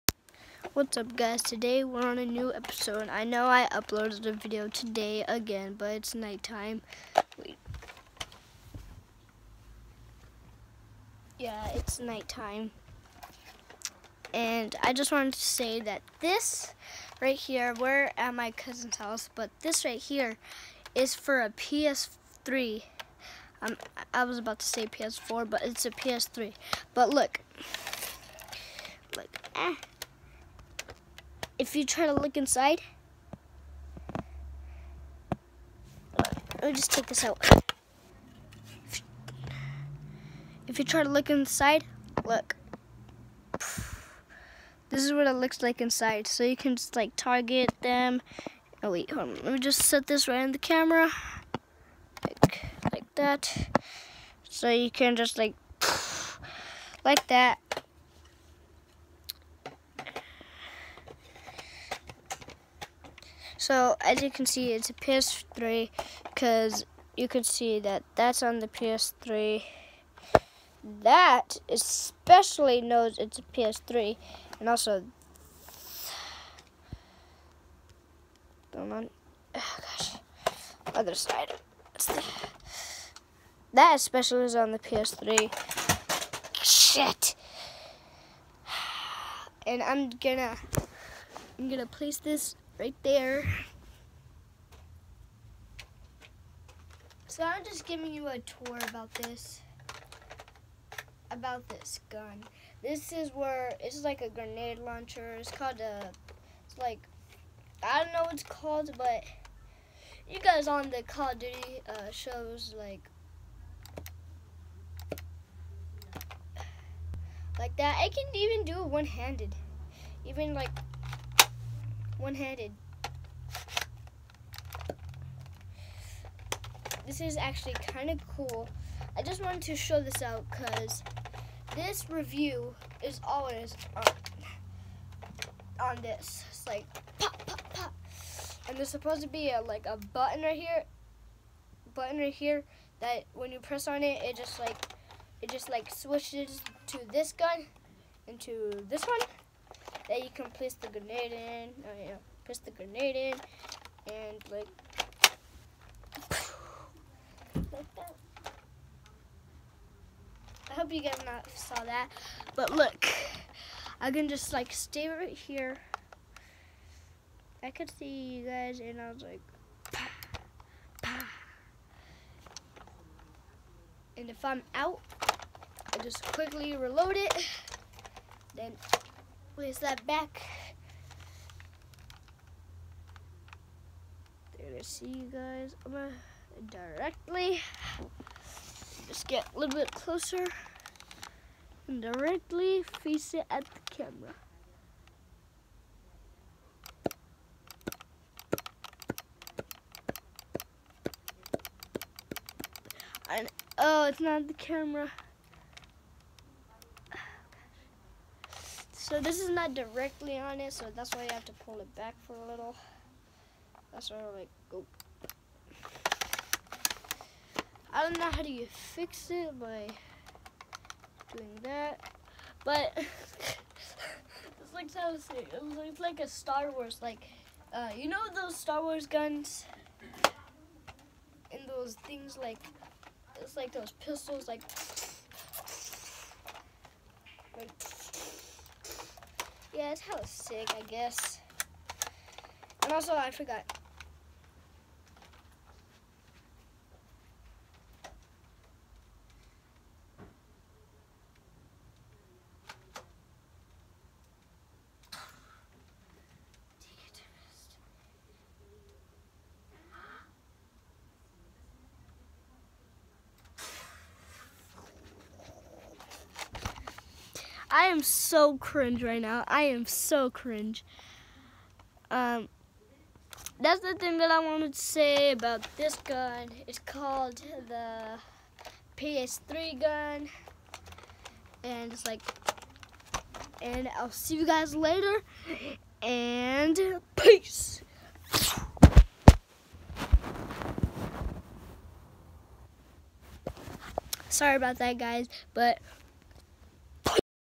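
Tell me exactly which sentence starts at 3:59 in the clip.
Yeah, it's hella sick, I guess.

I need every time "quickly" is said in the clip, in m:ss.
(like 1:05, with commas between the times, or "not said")
2:56.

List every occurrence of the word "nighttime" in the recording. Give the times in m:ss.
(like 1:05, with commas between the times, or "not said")
0:06, 0:11.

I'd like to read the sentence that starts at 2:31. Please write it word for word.
Oh yeah, place the grenade in and like like that.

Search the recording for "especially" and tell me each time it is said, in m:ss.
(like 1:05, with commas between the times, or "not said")
1:11, 1:23.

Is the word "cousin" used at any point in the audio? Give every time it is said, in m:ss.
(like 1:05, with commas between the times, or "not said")
0:18.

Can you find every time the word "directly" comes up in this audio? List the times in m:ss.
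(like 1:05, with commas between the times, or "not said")
3:06, 3:12, 3:29.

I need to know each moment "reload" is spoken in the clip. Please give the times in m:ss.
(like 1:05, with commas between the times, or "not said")
2:56.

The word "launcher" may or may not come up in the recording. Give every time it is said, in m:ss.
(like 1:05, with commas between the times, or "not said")
1:44.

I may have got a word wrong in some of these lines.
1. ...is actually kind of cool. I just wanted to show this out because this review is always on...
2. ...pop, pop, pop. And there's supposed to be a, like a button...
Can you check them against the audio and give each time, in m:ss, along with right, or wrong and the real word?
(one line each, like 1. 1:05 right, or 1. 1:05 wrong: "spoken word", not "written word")
1. 2:07 right
2. 2:17 right.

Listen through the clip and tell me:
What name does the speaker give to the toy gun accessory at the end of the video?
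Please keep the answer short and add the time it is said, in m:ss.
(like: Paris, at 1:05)
PS3 gun, at 4:38.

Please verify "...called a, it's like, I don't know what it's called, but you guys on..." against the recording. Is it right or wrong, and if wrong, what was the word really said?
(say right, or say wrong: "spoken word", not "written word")
right.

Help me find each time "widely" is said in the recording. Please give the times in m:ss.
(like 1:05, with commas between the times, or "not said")
not said.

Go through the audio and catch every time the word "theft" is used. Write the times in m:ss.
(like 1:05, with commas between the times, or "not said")
not said.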